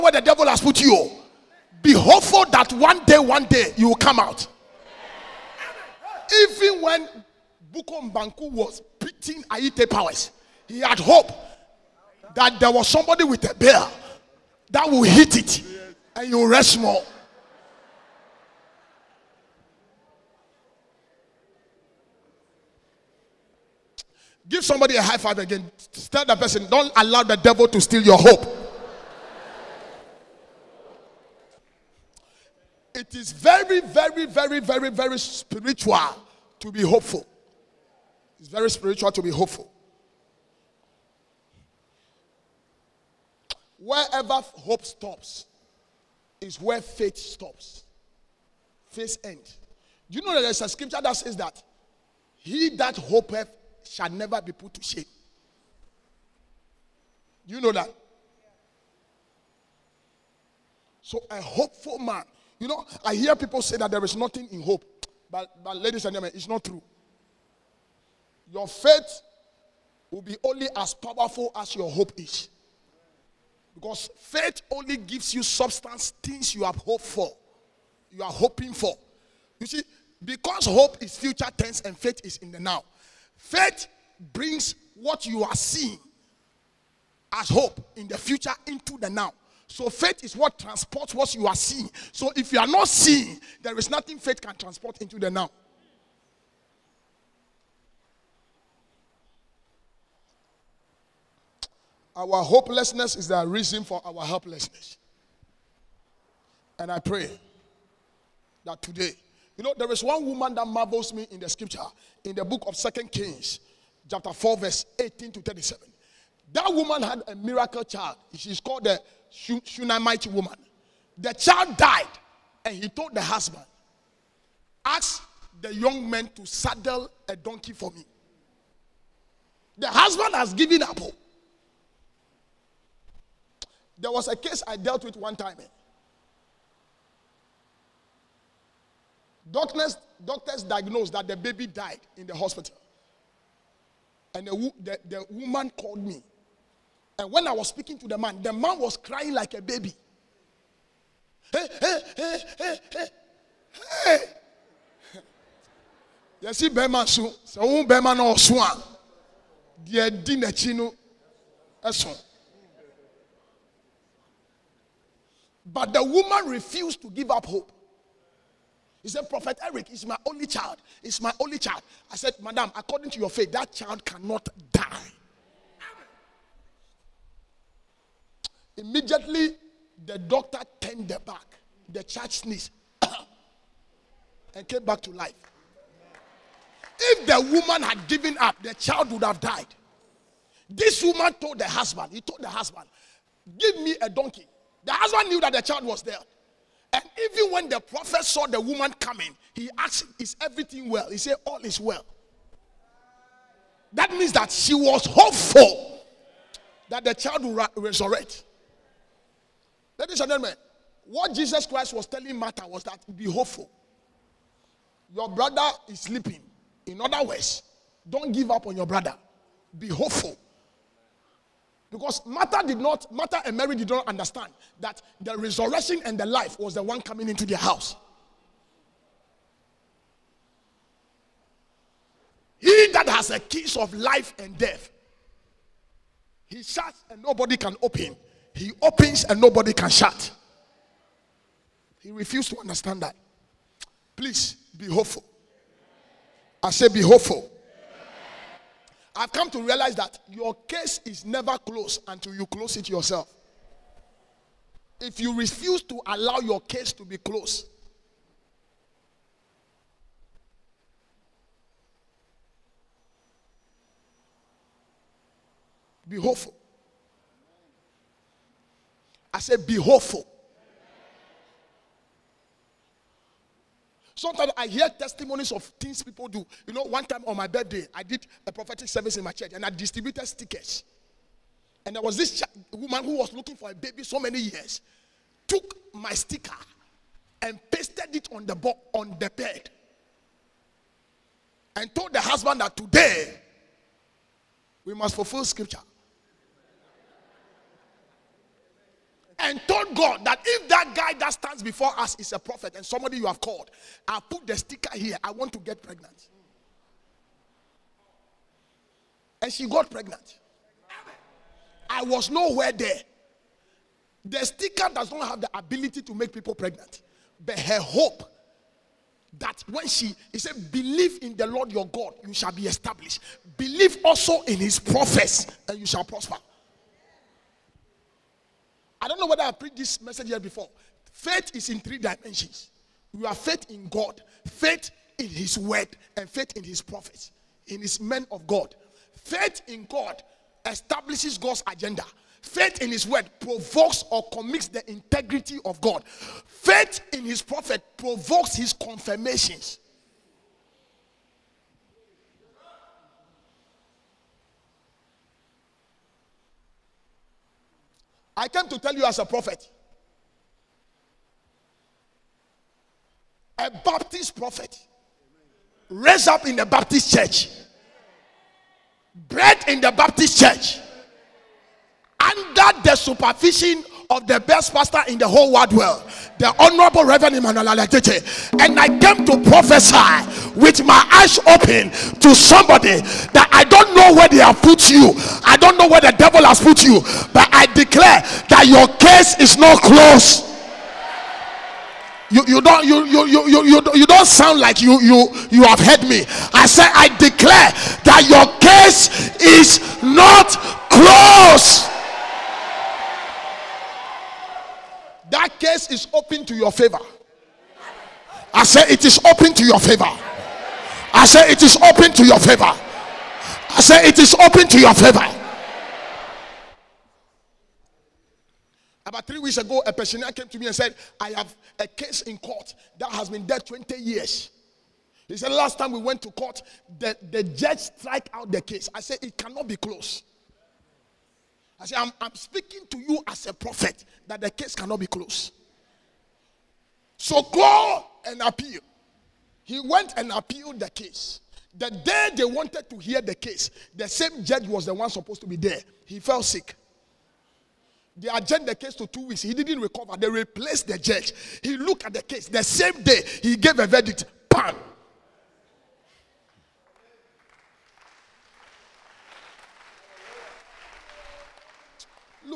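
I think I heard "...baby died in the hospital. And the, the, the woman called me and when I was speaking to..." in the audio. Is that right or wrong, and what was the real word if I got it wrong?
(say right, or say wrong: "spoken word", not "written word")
right.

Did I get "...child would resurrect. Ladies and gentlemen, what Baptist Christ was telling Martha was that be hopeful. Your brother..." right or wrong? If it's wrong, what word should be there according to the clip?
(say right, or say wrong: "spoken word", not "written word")
wrong: "Jesus", not "Baptist".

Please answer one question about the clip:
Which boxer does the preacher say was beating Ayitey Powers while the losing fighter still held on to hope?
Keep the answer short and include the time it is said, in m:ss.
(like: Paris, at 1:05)
Bukom Banku, at 0:07.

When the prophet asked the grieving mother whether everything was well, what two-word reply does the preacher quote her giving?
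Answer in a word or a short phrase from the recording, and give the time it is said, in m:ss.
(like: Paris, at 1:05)
All is well, at 3:21.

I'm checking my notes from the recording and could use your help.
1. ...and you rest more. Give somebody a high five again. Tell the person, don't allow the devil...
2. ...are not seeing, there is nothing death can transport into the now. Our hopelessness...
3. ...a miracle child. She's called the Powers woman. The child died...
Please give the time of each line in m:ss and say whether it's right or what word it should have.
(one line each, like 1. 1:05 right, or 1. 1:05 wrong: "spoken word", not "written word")
1. 0:16 right
2. 1:32 wrong: "faith", not "death"
3. 1:57 wrong: "Shunammite", not "Powers".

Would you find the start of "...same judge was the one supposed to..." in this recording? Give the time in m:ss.
7:24.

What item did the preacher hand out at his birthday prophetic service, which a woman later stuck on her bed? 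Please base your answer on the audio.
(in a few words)
Stickers.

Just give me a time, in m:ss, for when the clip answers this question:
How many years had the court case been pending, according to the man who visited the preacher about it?
7:03.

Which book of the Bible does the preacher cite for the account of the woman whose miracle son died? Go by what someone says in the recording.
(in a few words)
Second Kings.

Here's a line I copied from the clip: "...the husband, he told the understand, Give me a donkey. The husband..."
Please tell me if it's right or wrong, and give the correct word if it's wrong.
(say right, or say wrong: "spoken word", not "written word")
wrong: "husband", not "understand".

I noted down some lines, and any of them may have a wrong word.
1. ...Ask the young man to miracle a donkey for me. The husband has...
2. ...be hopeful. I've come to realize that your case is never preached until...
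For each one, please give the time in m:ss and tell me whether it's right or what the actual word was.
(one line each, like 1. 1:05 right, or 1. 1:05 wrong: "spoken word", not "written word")
1. 2:04 wrong: "saddle", not "miracle"
2. 4:06 wrong: "closed", not "preached".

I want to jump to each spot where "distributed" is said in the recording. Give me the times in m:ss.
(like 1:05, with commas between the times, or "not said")
4:39.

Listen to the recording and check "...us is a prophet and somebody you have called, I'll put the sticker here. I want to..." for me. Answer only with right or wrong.
right.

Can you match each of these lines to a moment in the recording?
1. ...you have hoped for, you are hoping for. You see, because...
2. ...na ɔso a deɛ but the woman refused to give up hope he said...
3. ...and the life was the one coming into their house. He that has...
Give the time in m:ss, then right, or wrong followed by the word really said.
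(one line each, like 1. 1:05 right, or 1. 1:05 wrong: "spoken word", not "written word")
1. 1:16 right
2. 2:38 right
3. 3:46 right.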